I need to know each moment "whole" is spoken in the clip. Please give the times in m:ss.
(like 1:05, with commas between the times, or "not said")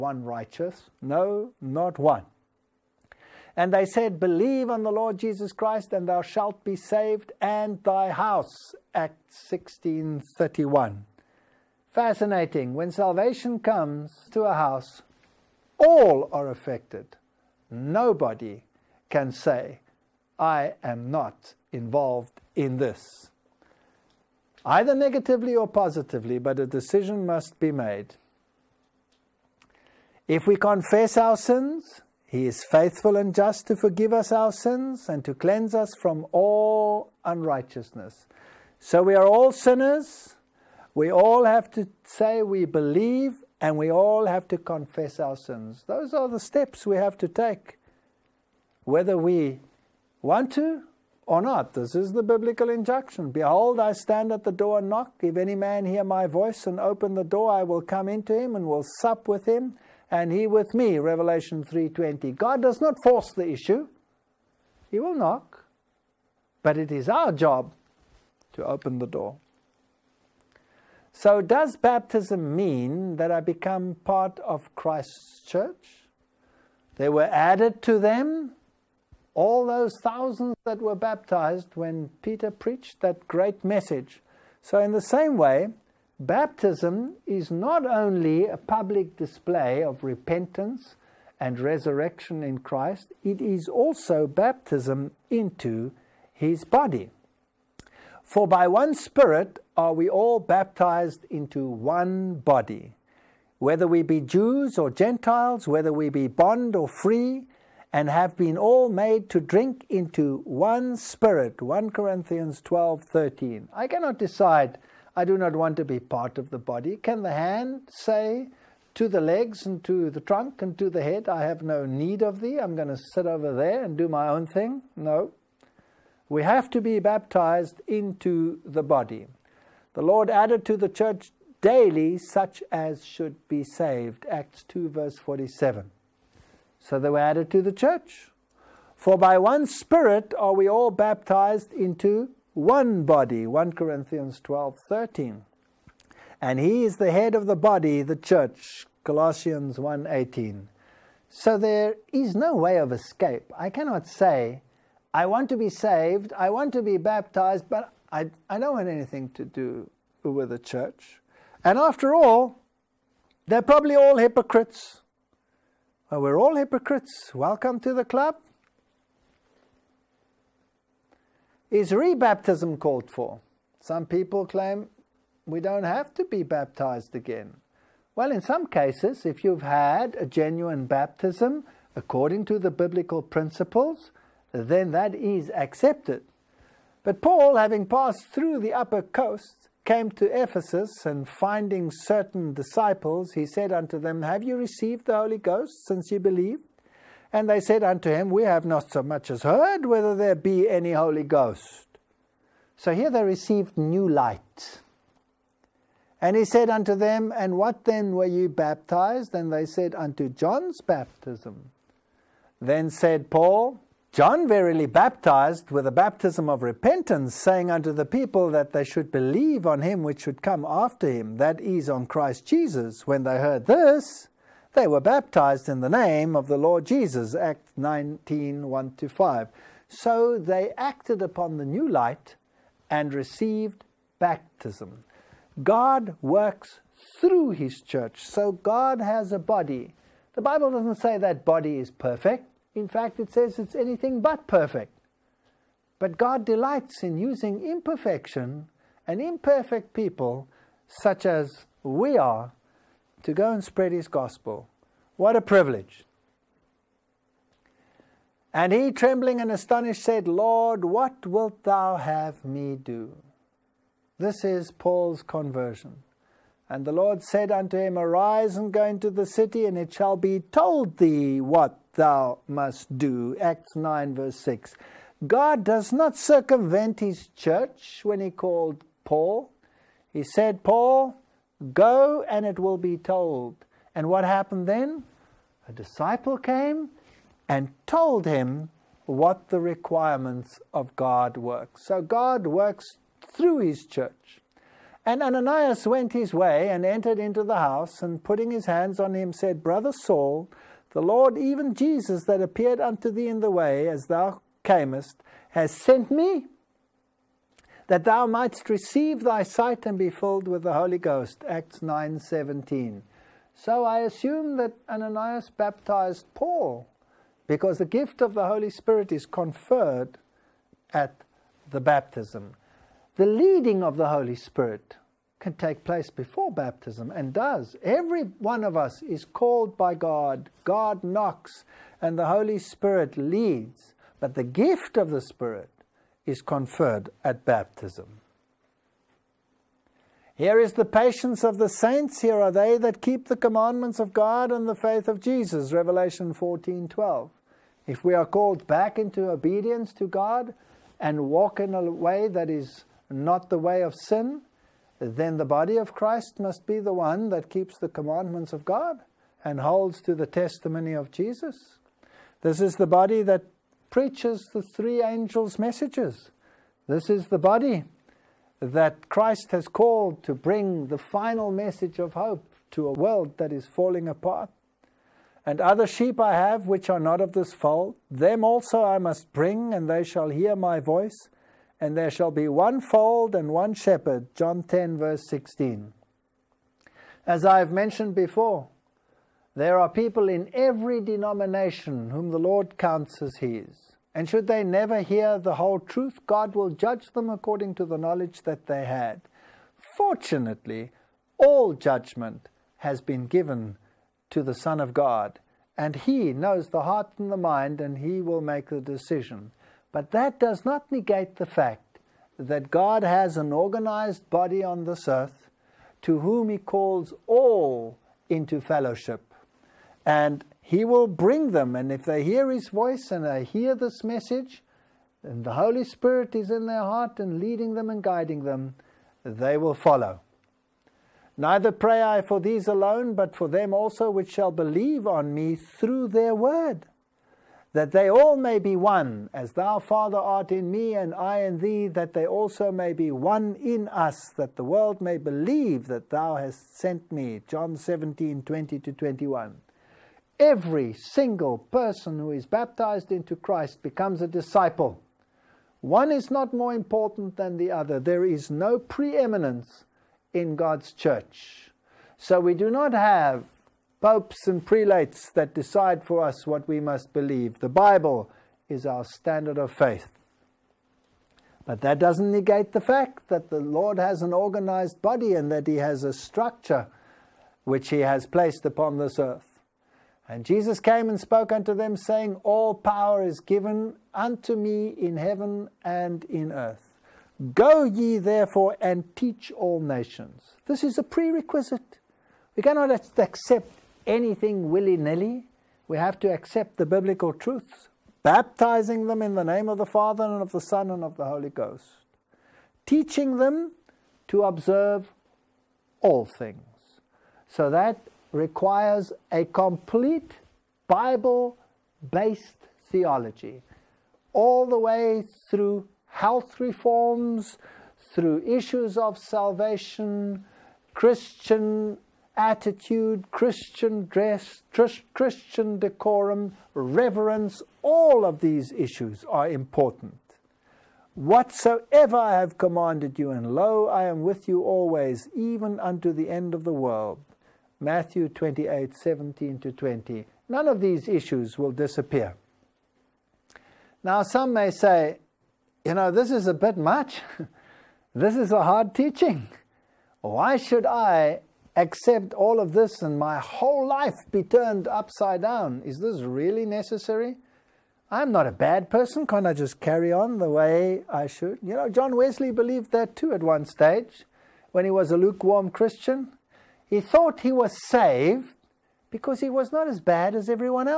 6:35, 9:13.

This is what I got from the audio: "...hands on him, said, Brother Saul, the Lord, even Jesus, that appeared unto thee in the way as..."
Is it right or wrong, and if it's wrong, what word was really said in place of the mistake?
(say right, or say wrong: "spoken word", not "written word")
right.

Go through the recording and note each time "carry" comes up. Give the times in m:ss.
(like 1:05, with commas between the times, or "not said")
9:19.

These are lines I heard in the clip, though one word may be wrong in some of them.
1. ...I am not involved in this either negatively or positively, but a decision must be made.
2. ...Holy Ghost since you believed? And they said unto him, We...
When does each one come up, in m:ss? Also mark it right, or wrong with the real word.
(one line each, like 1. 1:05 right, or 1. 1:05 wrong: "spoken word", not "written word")
1. 0:20 right
2. 3:15 right.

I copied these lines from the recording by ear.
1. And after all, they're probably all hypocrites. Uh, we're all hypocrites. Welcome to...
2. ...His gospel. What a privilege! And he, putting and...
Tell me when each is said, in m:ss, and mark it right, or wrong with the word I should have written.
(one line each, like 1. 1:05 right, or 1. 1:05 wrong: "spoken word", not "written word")
1. 2:41 right
2. 4:13 wrong: "trembling", not "putting".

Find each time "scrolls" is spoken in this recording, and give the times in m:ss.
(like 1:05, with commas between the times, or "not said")
not said.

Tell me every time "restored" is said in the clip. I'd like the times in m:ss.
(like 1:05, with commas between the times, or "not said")
not said.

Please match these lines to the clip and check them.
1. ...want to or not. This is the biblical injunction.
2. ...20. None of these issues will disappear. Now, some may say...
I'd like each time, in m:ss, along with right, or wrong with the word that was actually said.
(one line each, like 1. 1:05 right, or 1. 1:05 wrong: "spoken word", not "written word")
1. 0:50 right
2. 8:59 right.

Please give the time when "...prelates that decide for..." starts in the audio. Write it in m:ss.
7:44.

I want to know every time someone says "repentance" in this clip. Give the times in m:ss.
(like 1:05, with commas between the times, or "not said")
1:30, 3:36.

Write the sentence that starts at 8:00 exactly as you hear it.
And Jesus came and spoke unto them, saying, All power is given unto me in heaven and in earth.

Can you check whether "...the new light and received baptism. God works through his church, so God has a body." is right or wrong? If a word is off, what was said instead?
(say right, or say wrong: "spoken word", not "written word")
right.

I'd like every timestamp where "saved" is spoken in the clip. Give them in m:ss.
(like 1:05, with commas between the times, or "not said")
0:06, 2:13, 2:35, 9:27.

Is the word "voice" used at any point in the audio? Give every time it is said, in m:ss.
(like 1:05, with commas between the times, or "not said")
0:56, 6:20, 7:02.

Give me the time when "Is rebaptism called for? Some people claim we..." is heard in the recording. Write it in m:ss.
2:51.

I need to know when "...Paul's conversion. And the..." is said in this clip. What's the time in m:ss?
4:24.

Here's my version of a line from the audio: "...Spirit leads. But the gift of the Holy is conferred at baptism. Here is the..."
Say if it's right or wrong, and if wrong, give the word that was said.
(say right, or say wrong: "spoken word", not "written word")
wrong: "Spirit", not "Holy".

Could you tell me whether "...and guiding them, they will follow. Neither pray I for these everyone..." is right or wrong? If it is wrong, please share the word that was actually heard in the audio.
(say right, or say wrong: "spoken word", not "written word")
wrong: "alone", not "everyone".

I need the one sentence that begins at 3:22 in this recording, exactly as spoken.
So here they received new light.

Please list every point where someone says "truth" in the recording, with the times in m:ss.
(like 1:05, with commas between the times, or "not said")
6:35, 8:17.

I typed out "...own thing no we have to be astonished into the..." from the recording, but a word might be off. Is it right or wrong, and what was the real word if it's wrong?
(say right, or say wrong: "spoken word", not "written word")
wrong: "baptized", not "astonished".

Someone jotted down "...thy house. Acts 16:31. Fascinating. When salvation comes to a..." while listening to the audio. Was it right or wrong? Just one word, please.
right.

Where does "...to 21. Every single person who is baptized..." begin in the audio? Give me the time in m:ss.
7:28.